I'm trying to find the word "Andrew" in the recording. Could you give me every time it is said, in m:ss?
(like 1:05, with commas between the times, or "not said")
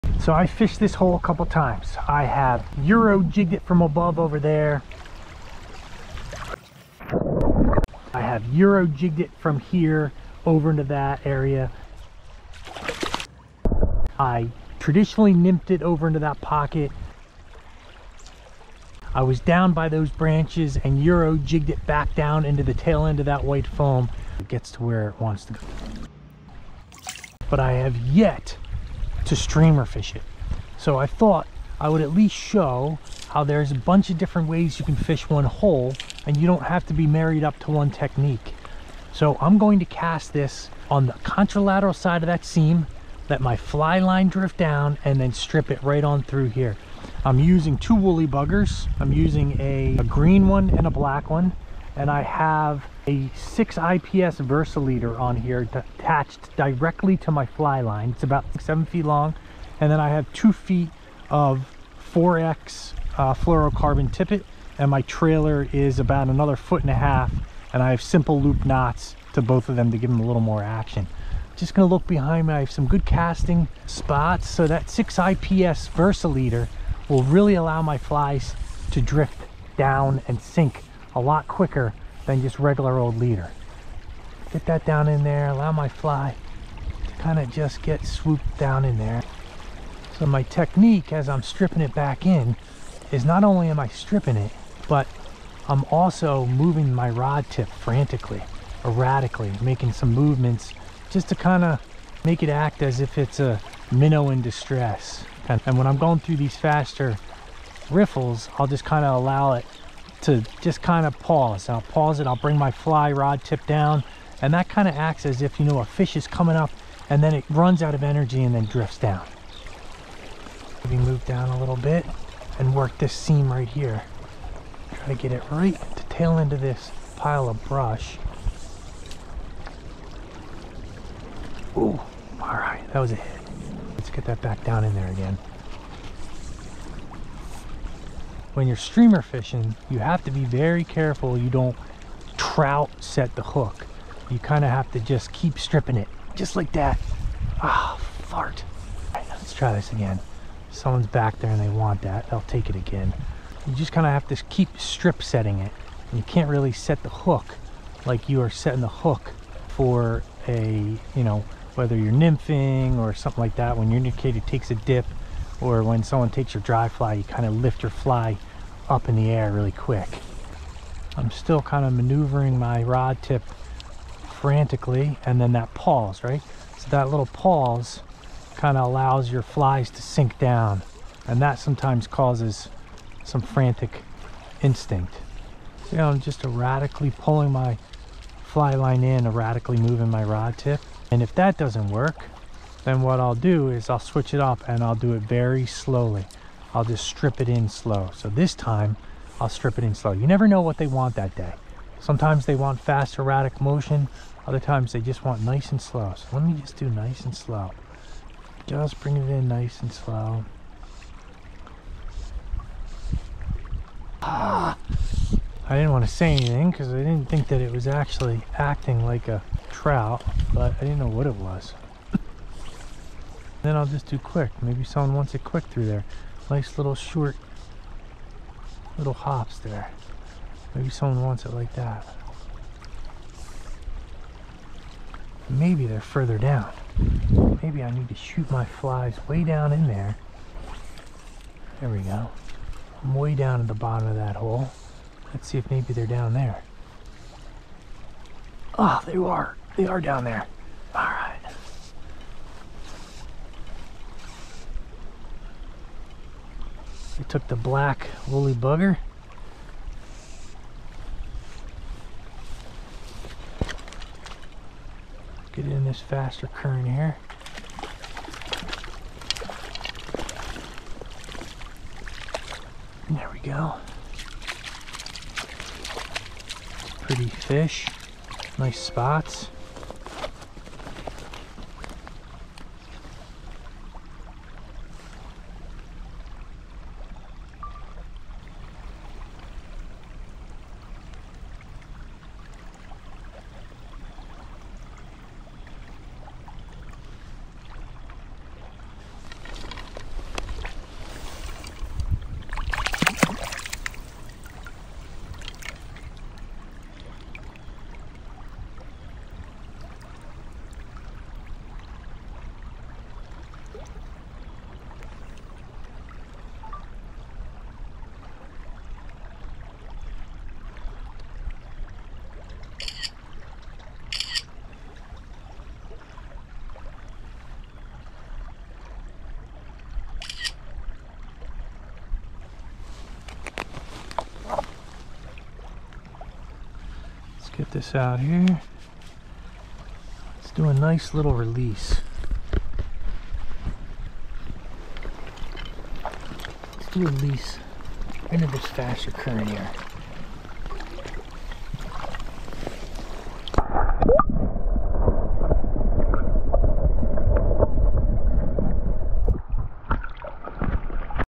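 not said.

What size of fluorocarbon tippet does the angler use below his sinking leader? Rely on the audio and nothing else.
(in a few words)
4X.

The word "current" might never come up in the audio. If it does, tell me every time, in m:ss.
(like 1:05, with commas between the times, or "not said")
4:26, 5:49.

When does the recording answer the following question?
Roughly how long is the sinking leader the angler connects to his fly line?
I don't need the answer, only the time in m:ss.
0:58.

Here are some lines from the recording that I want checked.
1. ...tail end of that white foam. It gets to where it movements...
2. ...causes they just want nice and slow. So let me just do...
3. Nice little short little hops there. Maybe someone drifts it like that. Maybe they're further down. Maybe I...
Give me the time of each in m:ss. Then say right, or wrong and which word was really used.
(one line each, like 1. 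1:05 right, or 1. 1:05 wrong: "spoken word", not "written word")
1. 0:22 wrong: "wants", not "movements"
2. 3:24 wrong: "times", not "causes"
3. 3:46 wrong: "wants", not "drifts".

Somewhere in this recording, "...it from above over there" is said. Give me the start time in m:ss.
0:03.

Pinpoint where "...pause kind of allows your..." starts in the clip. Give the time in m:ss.
2:57.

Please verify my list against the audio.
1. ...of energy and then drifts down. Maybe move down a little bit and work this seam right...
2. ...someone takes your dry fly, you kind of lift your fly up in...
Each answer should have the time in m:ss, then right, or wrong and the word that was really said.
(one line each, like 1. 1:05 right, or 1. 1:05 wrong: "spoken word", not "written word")
1. 1:57 right
2. 2:46 right.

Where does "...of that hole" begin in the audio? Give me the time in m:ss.
4:04.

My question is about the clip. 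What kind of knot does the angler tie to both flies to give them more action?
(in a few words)
loop knots.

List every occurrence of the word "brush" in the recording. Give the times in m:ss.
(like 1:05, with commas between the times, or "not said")
2:07.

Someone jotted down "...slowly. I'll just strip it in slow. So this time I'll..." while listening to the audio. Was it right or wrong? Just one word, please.
right.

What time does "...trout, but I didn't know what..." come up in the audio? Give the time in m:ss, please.
3:39.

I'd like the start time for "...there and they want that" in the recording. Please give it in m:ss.
2:31.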